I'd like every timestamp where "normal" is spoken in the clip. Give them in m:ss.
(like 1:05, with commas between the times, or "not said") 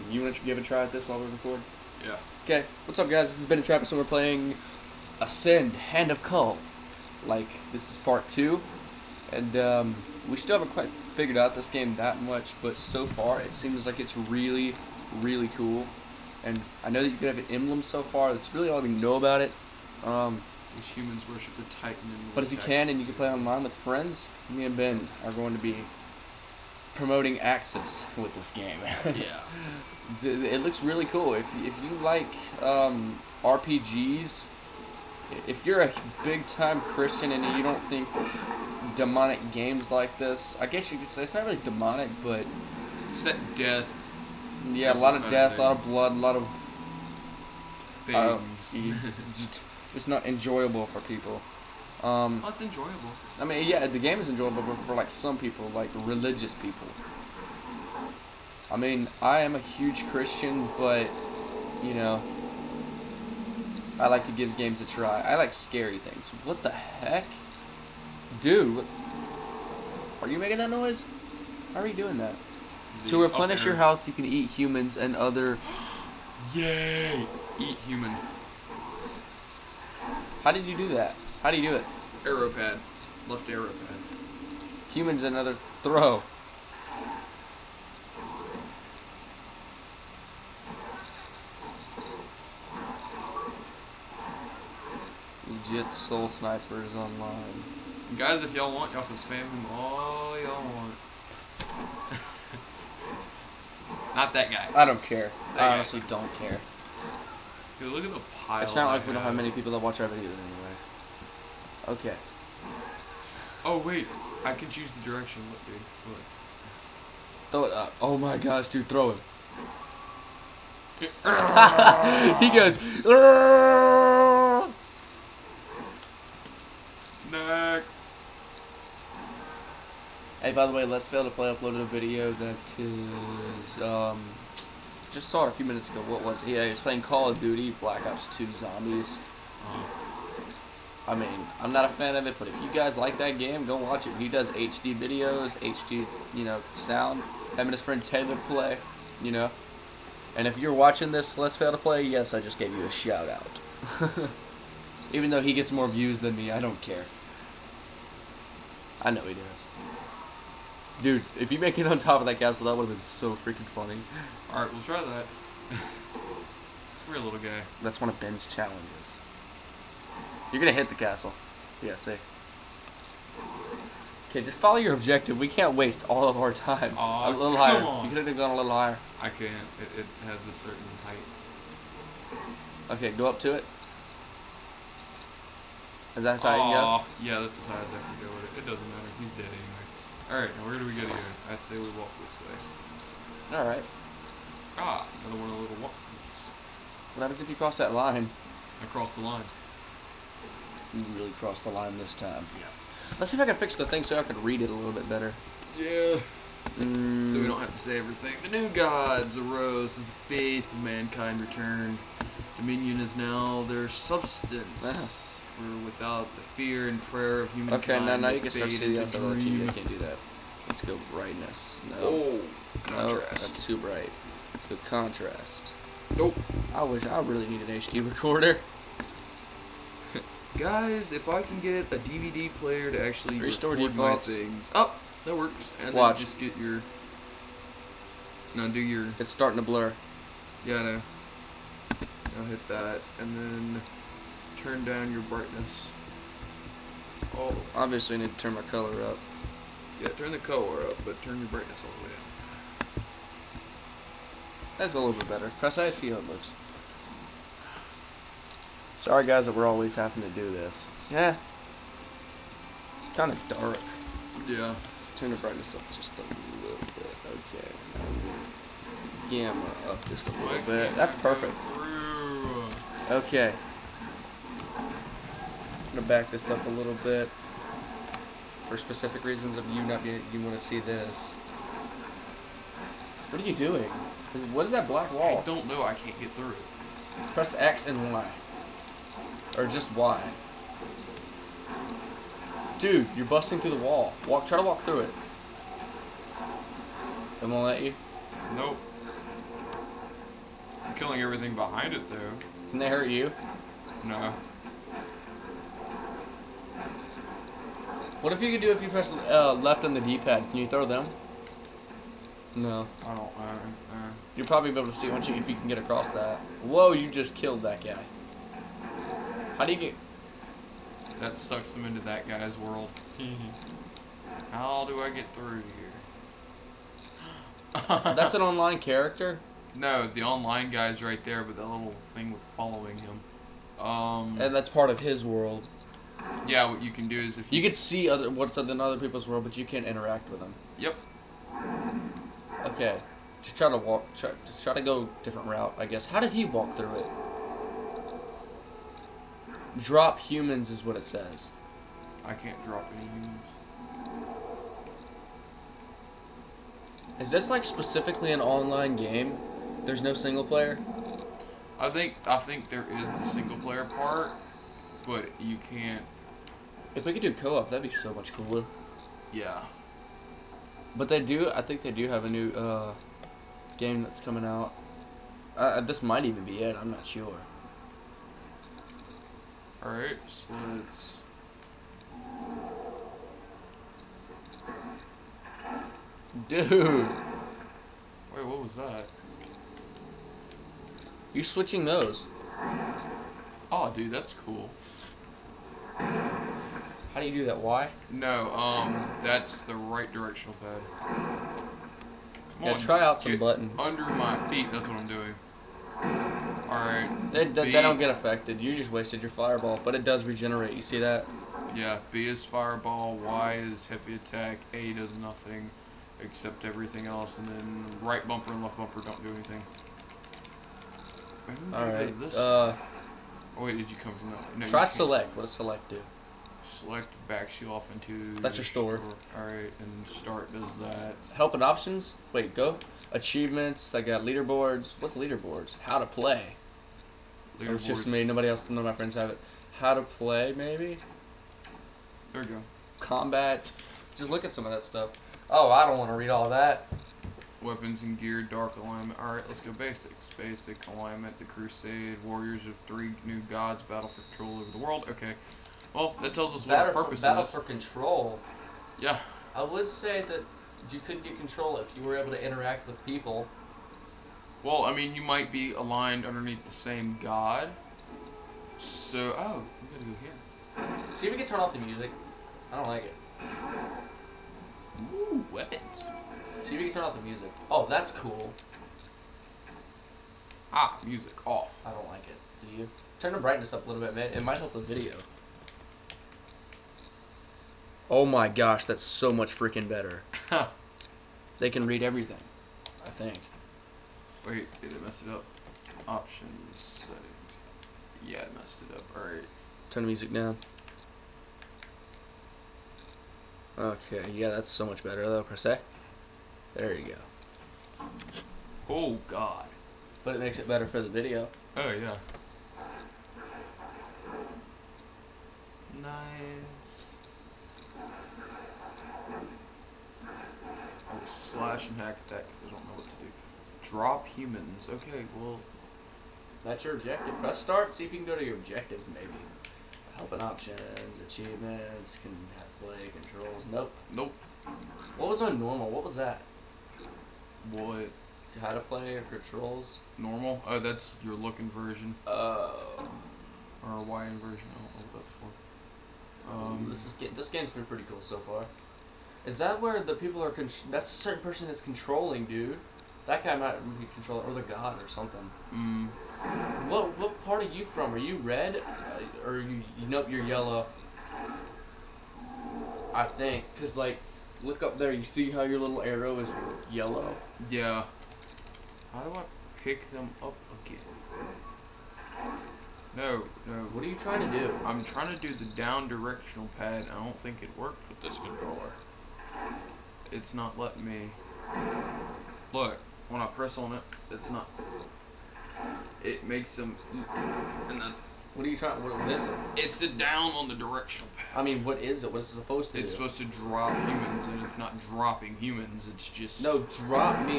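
8:55, 9:00.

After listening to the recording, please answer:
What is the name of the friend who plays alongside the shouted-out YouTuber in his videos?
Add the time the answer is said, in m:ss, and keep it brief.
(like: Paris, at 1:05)
Taylor, at 2:28.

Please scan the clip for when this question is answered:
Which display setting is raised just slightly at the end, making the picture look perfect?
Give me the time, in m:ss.
4:29.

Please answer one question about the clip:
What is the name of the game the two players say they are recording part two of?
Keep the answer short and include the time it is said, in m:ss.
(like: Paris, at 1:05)
Ascend Hand of Kul, at 0:05.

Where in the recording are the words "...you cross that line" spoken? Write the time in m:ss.
3:17.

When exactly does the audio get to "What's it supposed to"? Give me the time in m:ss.
9:52.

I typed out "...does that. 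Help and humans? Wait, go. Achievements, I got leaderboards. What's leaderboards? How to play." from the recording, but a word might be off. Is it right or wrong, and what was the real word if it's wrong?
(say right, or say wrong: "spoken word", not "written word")
wrong: "options", not "humans".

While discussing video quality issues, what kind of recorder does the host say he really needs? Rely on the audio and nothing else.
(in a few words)
An HD recorder.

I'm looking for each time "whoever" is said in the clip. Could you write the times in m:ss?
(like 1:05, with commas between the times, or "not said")
not said.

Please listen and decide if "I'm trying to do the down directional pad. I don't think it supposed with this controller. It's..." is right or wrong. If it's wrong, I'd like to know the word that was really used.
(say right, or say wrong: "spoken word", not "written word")
wrong: "worked", not "supposed".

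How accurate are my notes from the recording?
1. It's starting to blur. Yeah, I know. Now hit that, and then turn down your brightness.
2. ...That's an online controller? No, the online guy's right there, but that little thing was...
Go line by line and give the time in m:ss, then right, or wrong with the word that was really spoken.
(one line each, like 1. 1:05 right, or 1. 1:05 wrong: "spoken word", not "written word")
1. 3:59 right
2. 5:28 wrong: "character", not "controller".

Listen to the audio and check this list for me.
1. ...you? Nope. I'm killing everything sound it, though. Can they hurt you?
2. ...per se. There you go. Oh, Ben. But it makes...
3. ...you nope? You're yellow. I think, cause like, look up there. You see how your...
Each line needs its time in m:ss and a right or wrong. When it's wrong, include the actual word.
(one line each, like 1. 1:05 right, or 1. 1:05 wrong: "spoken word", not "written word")
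1. 4:57 wrong: "behind", not "sound"
2. 8:25 wrong: "God", not "Ben"
3. 9:19 right.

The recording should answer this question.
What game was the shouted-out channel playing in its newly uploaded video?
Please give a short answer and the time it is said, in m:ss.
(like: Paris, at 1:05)
Call of Duty Black Ops 2 Zombies, at 2:17.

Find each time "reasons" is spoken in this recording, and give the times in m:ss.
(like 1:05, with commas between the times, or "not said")
4:39.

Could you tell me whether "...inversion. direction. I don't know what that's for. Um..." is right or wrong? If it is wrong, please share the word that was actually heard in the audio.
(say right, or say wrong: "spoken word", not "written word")
wrong: "version", not "direction".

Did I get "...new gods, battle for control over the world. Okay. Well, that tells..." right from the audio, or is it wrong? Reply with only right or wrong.
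right.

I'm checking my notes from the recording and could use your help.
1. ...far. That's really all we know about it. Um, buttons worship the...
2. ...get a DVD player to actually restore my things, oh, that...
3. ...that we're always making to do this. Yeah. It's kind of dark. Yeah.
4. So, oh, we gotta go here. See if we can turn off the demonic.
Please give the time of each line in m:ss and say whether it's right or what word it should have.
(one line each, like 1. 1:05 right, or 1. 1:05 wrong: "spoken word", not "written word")
1. 0:18 wrong: "humans", not "buttons"
2. 3:51 right
3. 4:19 wrong: "having", not "making"
4. 7:48 wrong: "music", not "demonic".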